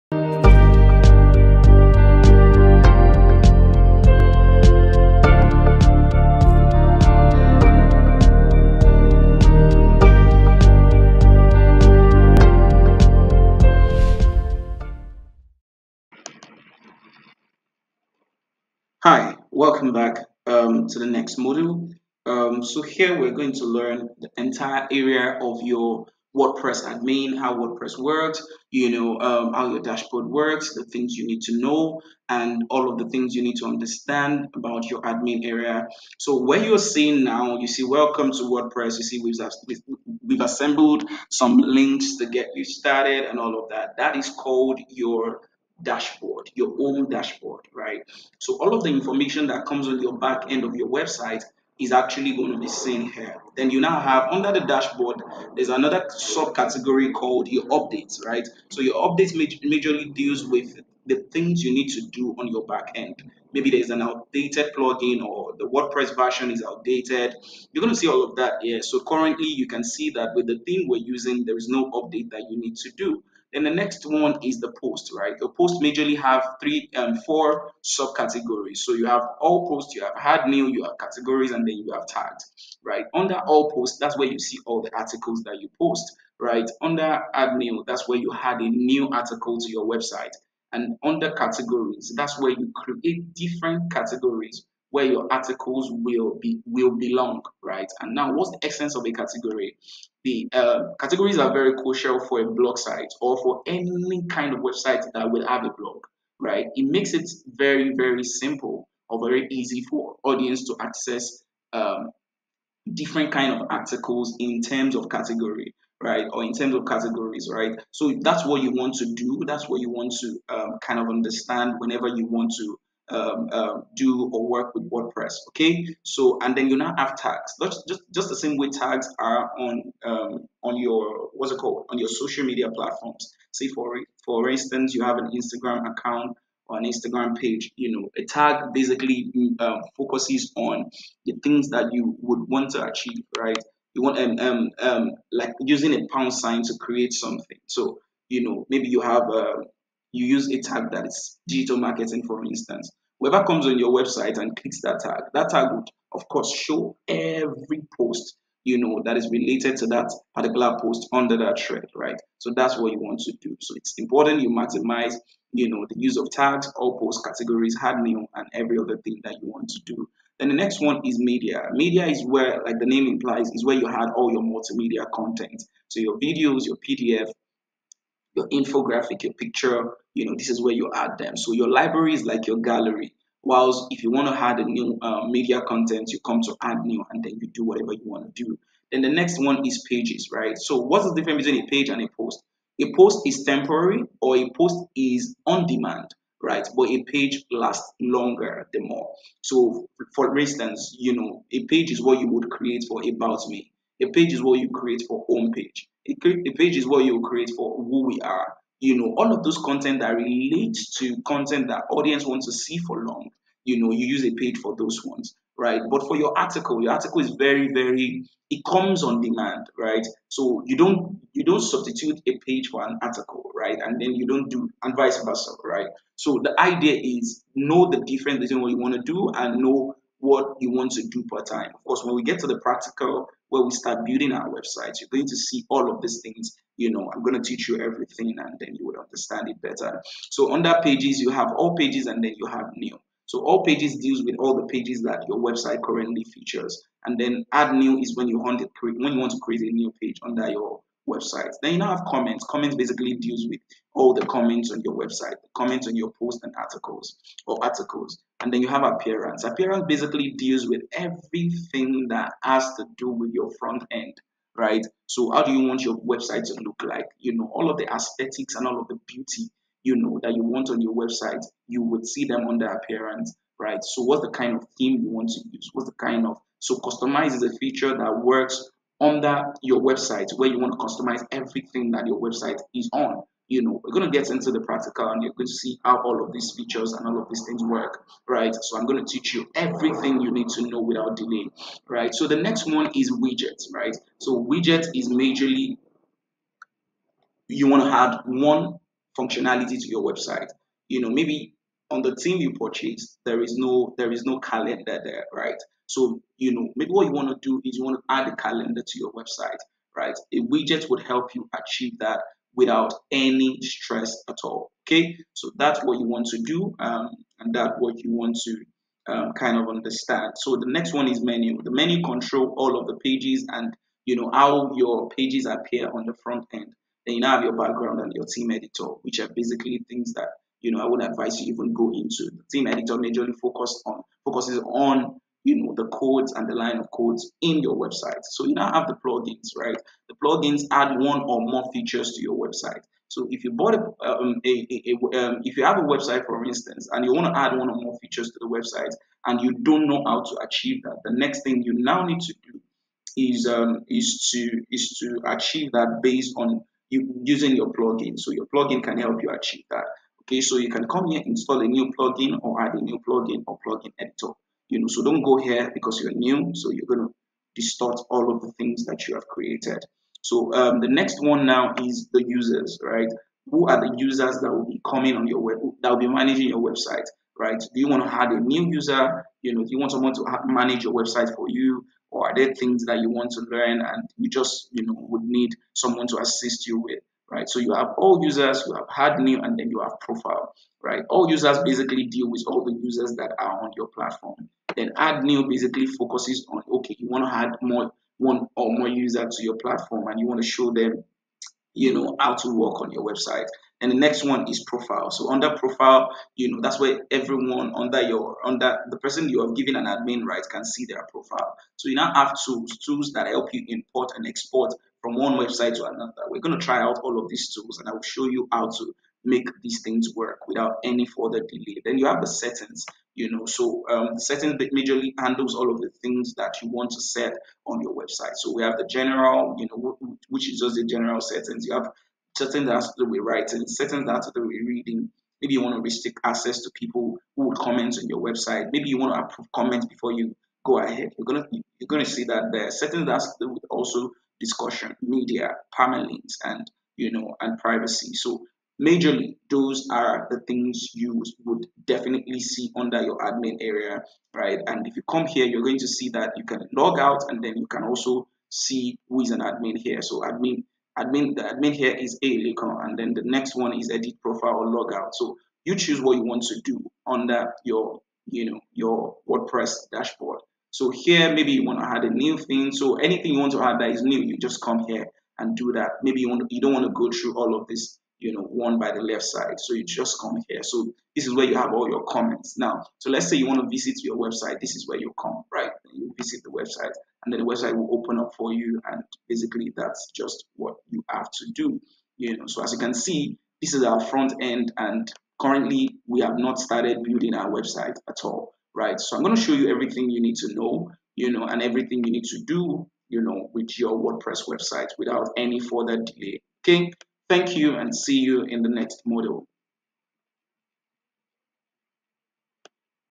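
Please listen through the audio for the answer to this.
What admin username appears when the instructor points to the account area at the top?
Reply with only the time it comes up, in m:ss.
7:42.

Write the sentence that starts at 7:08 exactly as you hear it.
So we have the general, you know, which is just the general settings.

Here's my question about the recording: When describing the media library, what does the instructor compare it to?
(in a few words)
your gallery.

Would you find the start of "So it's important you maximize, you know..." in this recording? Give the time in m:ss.
2:43.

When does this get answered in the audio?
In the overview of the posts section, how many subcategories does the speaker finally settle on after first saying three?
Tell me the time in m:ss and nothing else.
1:17.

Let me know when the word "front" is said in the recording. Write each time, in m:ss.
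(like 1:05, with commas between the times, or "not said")
4:23, 5:26, 8:13.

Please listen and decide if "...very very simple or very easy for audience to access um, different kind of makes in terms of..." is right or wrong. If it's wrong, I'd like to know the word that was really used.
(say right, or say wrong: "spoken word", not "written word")
wrong: "articles", not "makes".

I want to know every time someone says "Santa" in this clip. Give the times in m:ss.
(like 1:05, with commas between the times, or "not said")
not said.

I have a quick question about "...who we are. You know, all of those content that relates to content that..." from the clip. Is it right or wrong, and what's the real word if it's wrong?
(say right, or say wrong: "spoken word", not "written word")
right.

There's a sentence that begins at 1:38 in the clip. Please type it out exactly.
And now, what's the essence of a category?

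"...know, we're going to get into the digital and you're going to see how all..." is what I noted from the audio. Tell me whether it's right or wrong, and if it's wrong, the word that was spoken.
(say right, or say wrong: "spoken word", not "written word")
wrong: "practical", not "digital".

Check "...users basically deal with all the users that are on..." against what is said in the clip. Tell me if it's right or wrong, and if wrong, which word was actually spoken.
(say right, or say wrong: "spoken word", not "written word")
right.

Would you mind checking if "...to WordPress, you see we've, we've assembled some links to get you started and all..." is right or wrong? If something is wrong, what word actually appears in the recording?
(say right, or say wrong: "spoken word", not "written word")
right.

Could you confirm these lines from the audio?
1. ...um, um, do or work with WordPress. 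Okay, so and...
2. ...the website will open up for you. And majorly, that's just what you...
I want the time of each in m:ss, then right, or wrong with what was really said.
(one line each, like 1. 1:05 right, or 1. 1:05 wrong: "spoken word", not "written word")
1. 2:03 right
2. 8:07 wrong: "basically", not "majorly".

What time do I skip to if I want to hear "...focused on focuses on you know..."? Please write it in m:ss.
5:33.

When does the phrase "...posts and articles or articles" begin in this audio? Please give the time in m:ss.
4:16.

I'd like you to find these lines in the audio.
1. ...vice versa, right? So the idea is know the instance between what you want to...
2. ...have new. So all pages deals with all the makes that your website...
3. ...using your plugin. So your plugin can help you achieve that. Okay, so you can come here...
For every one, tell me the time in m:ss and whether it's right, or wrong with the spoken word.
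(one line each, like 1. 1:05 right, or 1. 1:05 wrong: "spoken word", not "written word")
1. 3:44 wrong: "difference", not "instance"
2. 4:02 wrong: "pages", not "makes"
3. 5:57 right.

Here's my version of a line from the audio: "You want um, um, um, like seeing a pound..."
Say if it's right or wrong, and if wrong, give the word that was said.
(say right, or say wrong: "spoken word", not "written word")
wrong: "using", not "seeing".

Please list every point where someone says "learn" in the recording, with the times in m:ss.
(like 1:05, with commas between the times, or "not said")
0:23, 6:23.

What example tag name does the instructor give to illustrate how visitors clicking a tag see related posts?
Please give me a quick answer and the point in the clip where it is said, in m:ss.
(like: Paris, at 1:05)
digital marketing, at 2:31.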